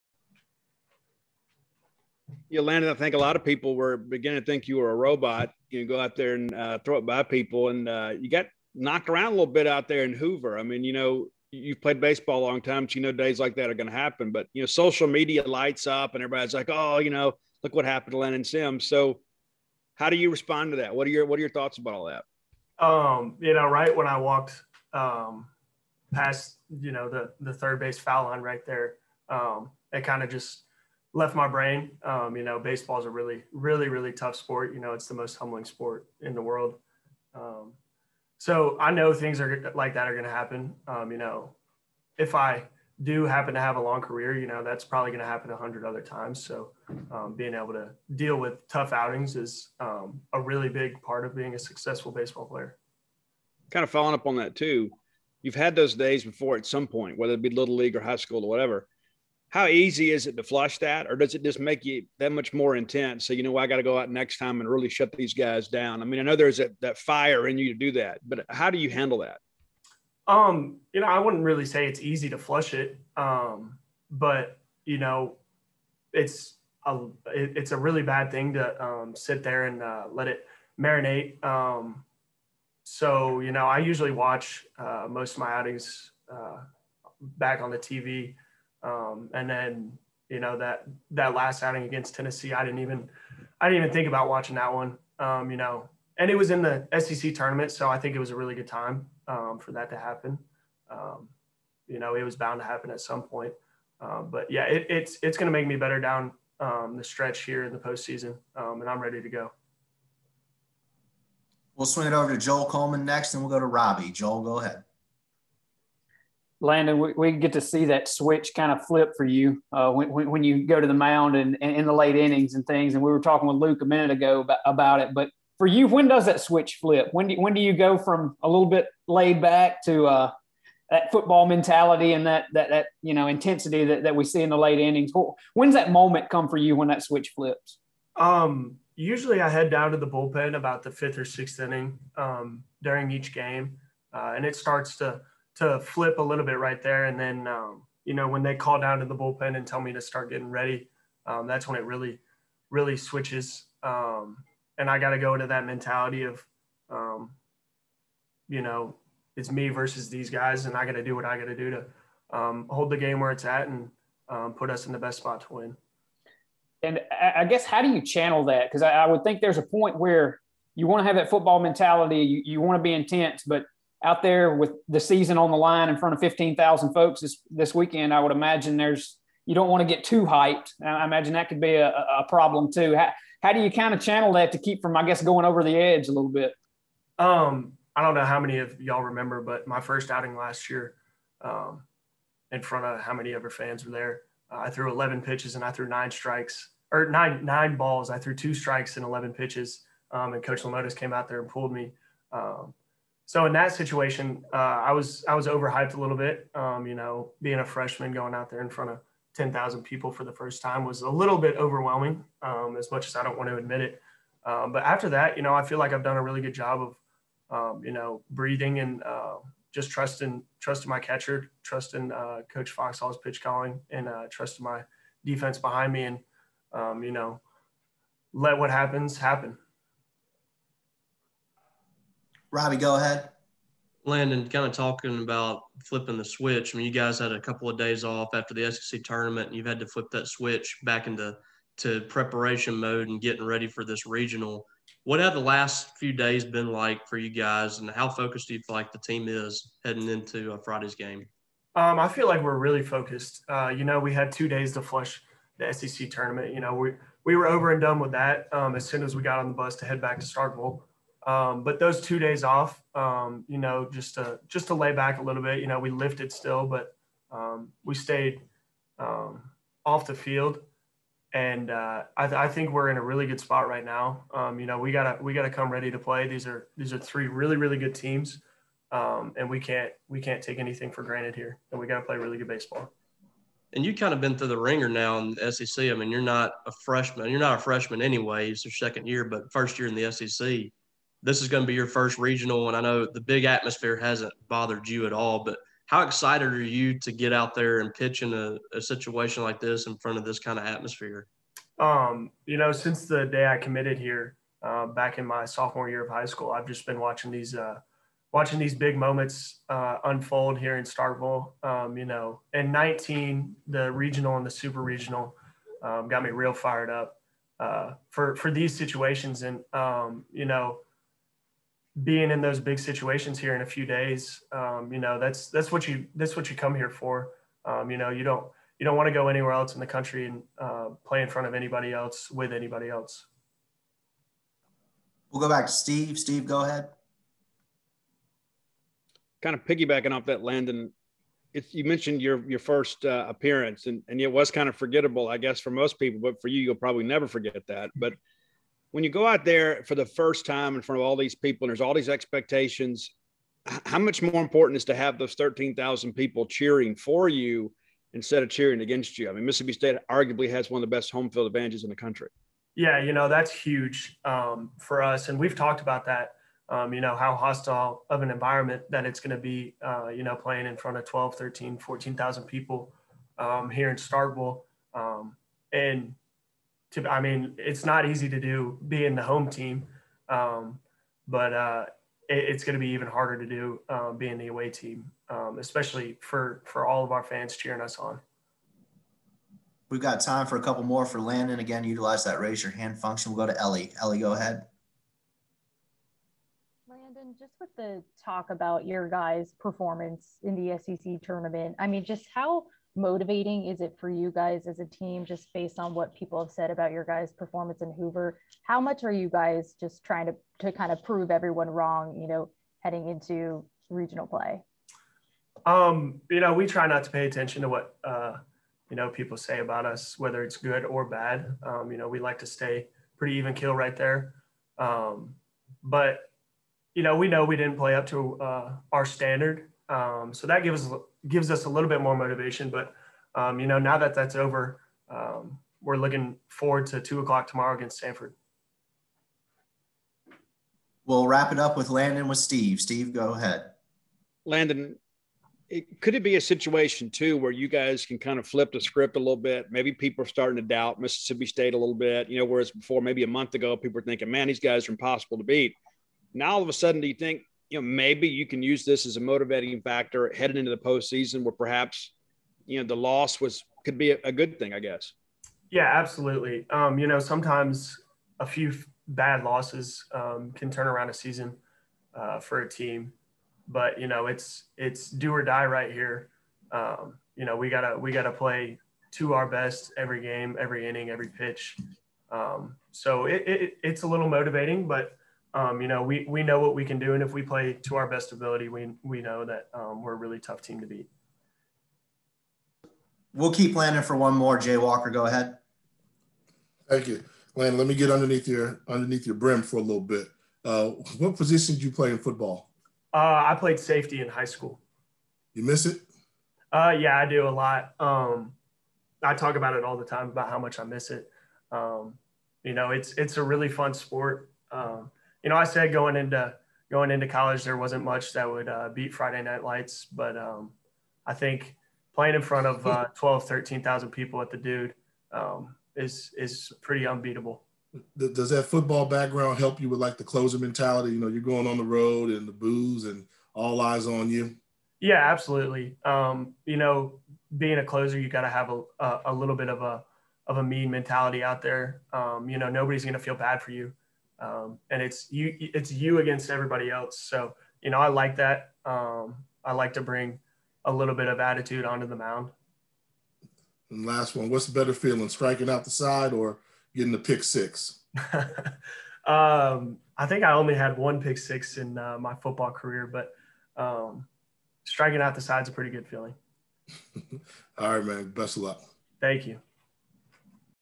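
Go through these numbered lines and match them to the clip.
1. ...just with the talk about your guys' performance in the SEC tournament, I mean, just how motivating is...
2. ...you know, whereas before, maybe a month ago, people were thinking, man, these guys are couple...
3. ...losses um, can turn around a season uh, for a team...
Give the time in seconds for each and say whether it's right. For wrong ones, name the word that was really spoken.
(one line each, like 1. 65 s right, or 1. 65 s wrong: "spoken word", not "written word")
1. 397 s right
2. 452 s wrong: "impossible", not "couple"
3. 469 s right.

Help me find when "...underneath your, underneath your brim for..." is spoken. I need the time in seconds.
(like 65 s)
498 s.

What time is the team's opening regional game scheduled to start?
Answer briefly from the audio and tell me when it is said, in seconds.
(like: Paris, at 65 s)
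2:00, at 437 s.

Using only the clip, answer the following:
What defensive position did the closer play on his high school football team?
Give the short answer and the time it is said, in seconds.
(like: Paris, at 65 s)
Safety, at 503 s.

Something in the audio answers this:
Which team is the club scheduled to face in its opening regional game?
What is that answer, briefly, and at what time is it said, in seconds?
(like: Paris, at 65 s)
Samford, at 438 s.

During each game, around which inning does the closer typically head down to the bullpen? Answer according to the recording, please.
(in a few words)
5th or 6th.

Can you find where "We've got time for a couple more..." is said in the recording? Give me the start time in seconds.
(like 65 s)
389 s.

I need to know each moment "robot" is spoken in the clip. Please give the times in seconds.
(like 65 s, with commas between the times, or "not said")
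4 s.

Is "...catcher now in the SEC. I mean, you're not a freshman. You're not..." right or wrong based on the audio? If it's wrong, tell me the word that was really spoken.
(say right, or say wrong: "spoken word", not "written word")
wrong: "wringer", not "catcher".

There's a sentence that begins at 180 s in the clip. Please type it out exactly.
I imagine that could be a, a problem too.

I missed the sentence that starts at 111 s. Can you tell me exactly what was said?
We'll swing it over to Joel Coleman next, and we'll go to Robbie.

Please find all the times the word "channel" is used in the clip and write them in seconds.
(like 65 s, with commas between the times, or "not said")
168 s, 183 s.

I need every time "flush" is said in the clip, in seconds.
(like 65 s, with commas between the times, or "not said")
60 s, 72 s, 254 s.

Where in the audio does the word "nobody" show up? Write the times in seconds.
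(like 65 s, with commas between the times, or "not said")
542 s.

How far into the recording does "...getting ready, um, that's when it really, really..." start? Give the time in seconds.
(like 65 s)
150 s.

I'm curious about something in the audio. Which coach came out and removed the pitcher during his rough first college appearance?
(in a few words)
Coach Lemonis.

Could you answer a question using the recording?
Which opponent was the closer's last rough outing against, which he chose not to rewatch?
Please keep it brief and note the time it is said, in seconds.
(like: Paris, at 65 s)
Tennessee, at 92 s.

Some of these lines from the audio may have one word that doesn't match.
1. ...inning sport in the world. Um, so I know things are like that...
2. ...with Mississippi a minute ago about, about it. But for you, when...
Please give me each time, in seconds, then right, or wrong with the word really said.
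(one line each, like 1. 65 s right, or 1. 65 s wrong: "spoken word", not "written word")
1. 35 s wrong: "humbling", not "inning"
2. 123 s wrong: "Luke", not "Mississippi".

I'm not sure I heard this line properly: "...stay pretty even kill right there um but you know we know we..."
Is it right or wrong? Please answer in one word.
right.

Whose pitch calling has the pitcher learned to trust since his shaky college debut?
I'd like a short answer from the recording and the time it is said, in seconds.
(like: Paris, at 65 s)
Coach Foxhall, at 222 s.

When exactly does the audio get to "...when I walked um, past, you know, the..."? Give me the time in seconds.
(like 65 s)
23 s.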